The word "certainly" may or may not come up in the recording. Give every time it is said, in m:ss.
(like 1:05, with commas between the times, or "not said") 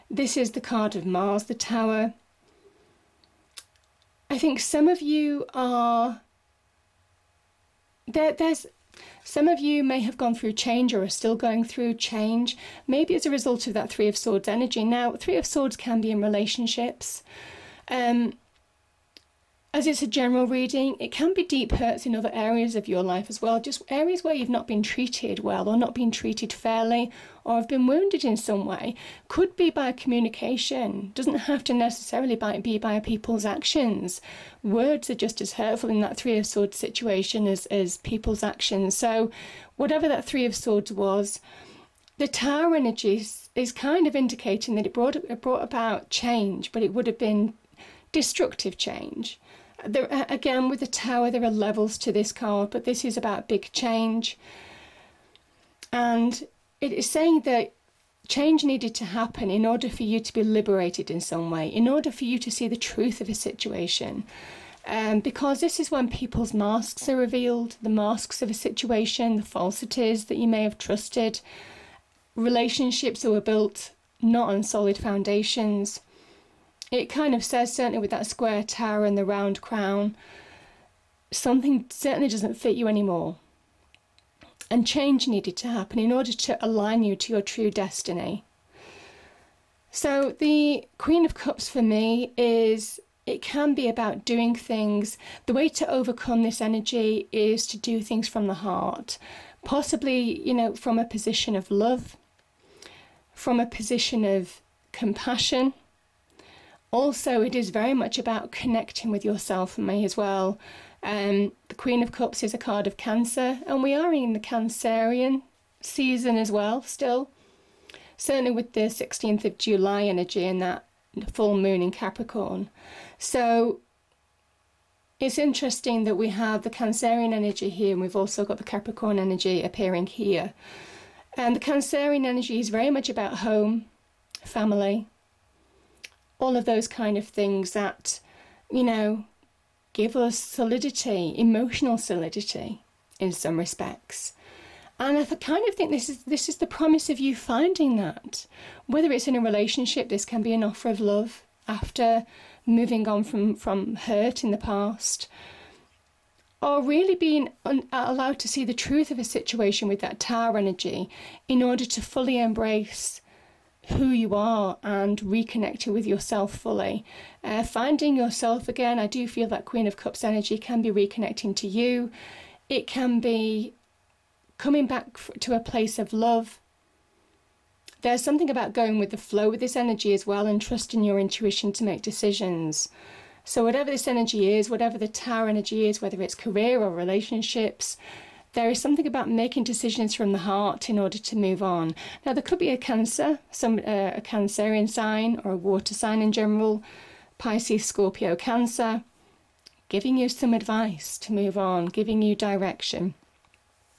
1:17, 1:21, 1:58.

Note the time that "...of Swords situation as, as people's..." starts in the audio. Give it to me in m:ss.
0:36.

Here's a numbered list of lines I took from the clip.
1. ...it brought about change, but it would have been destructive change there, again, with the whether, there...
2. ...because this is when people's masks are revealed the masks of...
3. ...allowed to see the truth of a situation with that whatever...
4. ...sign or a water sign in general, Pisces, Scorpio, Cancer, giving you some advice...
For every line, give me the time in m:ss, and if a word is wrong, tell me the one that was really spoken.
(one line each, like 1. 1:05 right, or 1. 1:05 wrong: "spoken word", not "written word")
1. 0:45 wrong: "tower", not "whether"
2. 1:05 right
3. 2:37 wrong: "tower", not "whatever"
4. 3:14 right.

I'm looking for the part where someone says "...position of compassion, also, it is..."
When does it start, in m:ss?
1:43.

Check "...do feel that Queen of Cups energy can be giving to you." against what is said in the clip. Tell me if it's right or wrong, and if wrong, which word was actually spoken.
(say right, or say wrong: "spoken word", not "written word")
wrong: "reconnecting", not "giving".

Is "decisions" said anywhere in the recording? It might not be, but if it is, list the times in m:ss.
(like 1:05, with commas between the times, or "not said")
3:02, 3:09.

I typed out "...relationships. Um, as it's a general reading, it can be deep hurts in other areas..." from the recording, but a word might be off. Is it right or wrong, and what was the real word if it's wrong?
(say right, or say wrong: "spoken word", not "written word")
right.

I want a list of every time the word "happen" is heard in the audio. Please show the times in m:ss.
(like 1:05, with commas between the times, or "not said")
0:59, 1:25.